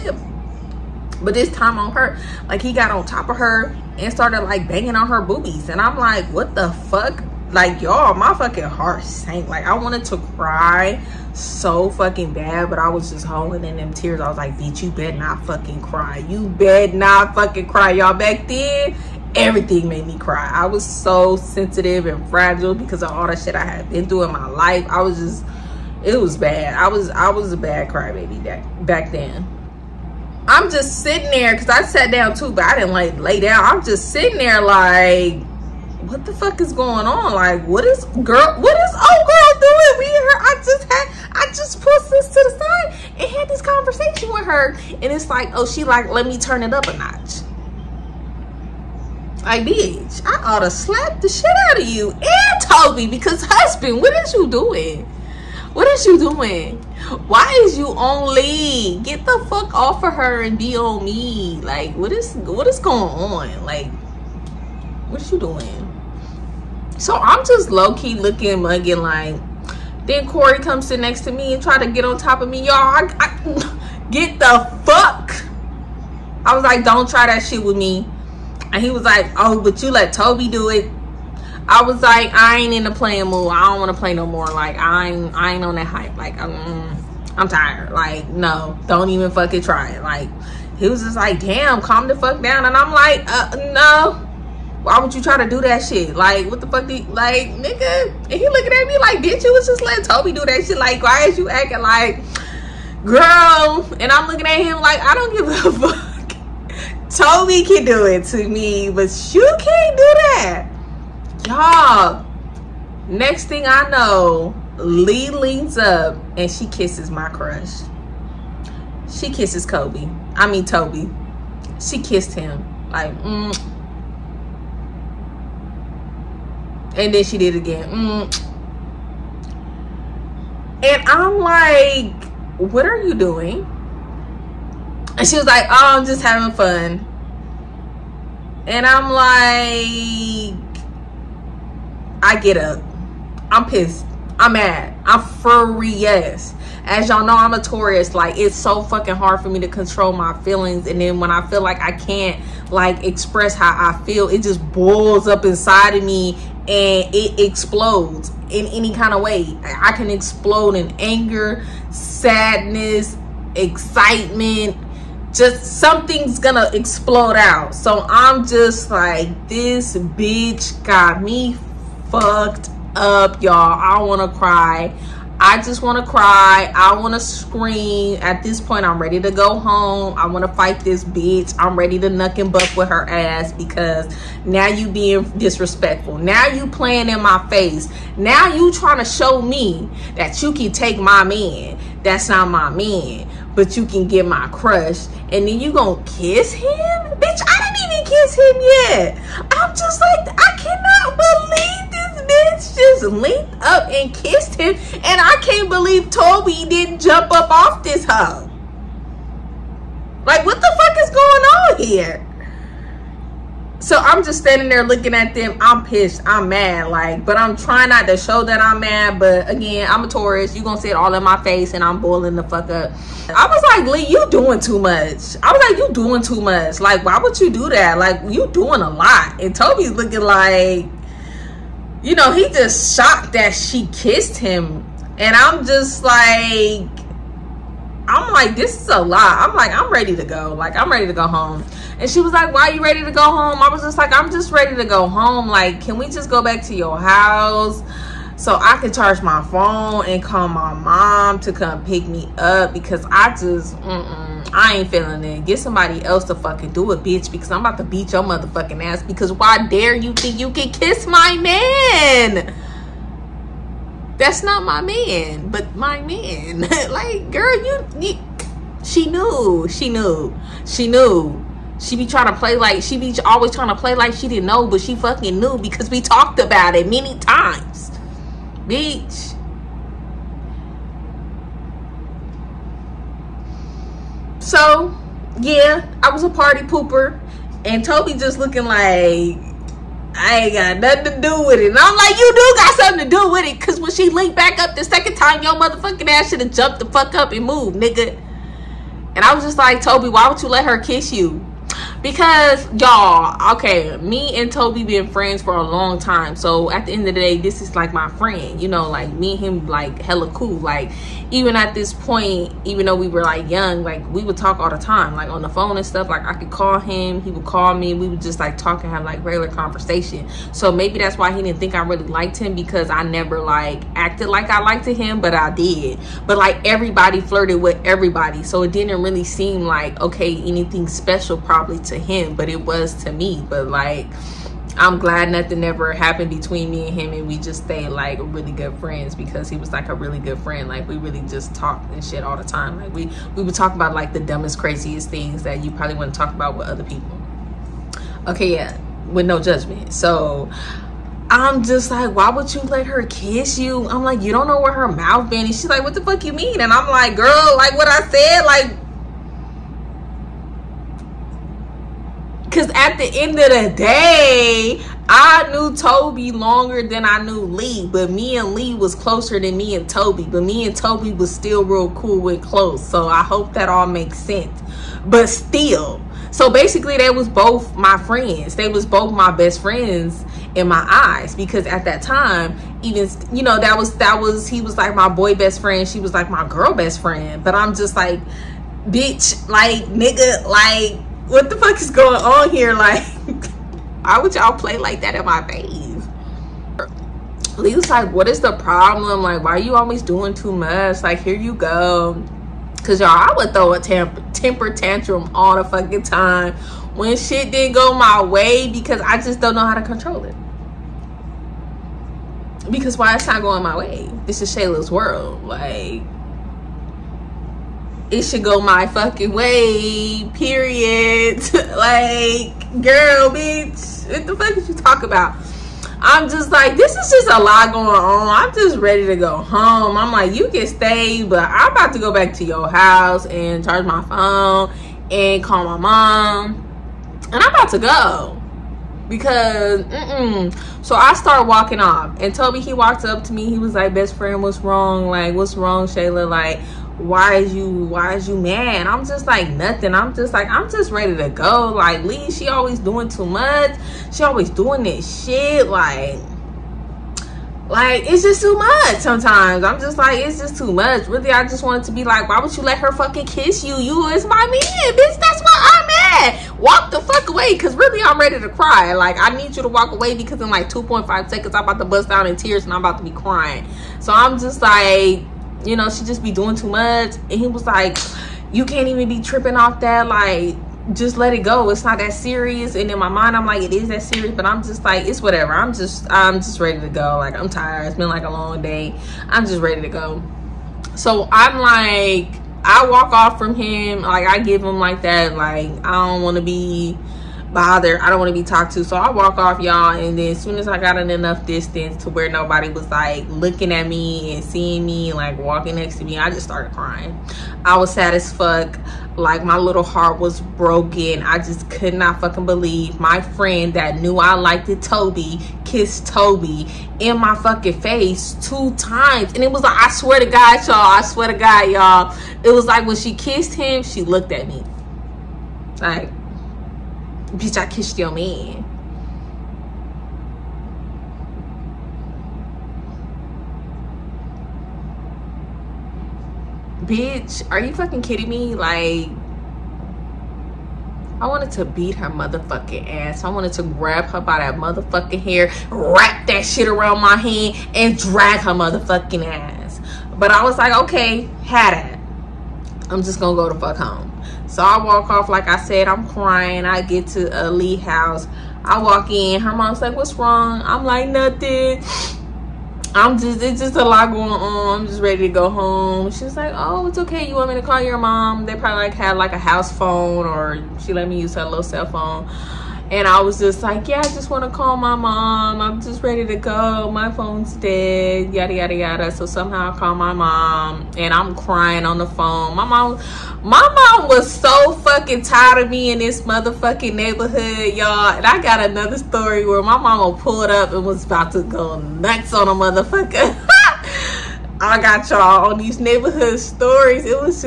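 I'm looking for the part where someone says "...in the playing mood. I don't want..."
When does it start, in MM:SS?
01:22.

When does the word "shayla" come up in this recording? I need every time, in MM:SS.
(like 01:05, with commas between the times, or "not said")
06:54, 07:25.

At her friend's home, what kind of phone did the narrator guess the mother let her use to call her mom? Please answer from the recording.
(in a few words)
house phone.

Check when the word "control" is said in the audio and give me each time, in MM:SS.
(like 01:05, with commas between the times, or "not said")
02:29, 06:49.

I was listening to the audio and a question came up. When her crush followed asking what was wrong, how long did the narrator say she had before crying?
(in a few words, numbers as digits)
2.5 seconds.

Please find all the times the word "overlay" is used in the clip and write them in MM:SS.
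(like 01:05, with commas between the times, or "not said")
not said.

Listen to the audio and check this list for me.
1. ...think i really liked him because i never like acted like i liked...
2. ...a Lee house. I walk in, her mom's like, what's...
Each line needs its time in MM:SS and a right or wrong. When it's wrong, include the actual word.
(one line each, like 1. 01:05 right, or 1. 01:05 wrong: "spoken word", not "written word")
1. 05:21 right
2. 09:17 right.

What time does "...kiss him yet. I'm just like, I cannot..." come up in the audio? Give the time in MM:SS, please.
03:18.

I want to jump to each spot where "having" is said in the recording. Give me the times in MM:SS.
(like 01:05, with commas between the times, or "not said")
02:16.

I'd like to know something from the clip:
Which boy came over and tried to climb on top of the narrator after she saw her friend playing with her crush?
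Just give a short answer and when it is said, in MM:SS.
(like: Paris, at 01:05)
Corey, at 01:10.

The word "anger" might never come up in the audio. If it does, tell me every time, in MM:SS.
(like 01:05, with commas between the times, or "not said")
02:40.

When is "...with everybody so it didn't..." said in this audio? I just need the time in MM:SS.
05:27.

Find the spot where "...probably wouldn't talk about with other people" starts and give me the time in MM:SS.
05:45.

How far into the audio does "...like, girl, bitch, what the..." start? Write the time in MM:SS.
07:01.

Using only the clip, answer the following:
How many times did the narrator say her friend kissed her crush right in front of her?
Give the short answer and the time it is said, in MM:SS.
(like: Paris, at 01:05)
two times, at 08:38.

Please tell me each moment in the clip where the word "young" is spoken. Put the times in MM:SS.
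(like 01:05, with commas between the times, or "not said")
05:13.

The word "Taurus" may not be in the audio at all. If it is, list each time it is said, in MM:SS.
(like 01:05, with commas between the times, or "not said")
02:27, 03:40.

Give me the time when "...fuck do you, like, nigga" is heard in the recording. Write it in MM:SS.
01:36.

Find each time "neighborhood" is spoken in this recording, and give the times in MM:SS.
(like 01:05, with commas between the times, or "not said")
09:46, 09:55.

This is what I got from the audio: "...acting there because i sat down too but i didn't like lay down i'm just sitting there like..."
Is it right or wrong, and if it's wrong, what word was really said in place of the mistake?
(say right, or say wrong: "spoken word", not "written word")
wrong: "sitting", not "acting".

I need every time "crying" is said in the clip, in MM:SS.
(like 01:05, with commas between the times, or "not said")
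07:53, 08:26, 09:16, 09:41.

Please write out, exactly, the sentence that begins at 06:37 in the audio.
Lisa's like, what is the problem?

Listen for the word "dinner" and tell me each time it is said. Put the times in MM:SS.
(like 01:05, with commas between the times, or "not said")
not said.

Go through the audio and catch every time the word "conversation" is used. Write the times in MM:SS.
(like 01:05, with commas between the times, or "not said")
00:43, 05:19.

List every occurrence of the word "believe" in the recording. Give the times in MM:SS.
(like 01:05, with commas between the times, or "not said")
03:21, 03:25, 08:32.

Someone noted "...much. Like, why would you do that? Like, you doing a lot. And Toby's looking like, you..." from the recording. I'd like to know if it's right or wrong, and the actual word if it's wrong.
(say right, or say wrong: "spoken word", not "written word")
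right.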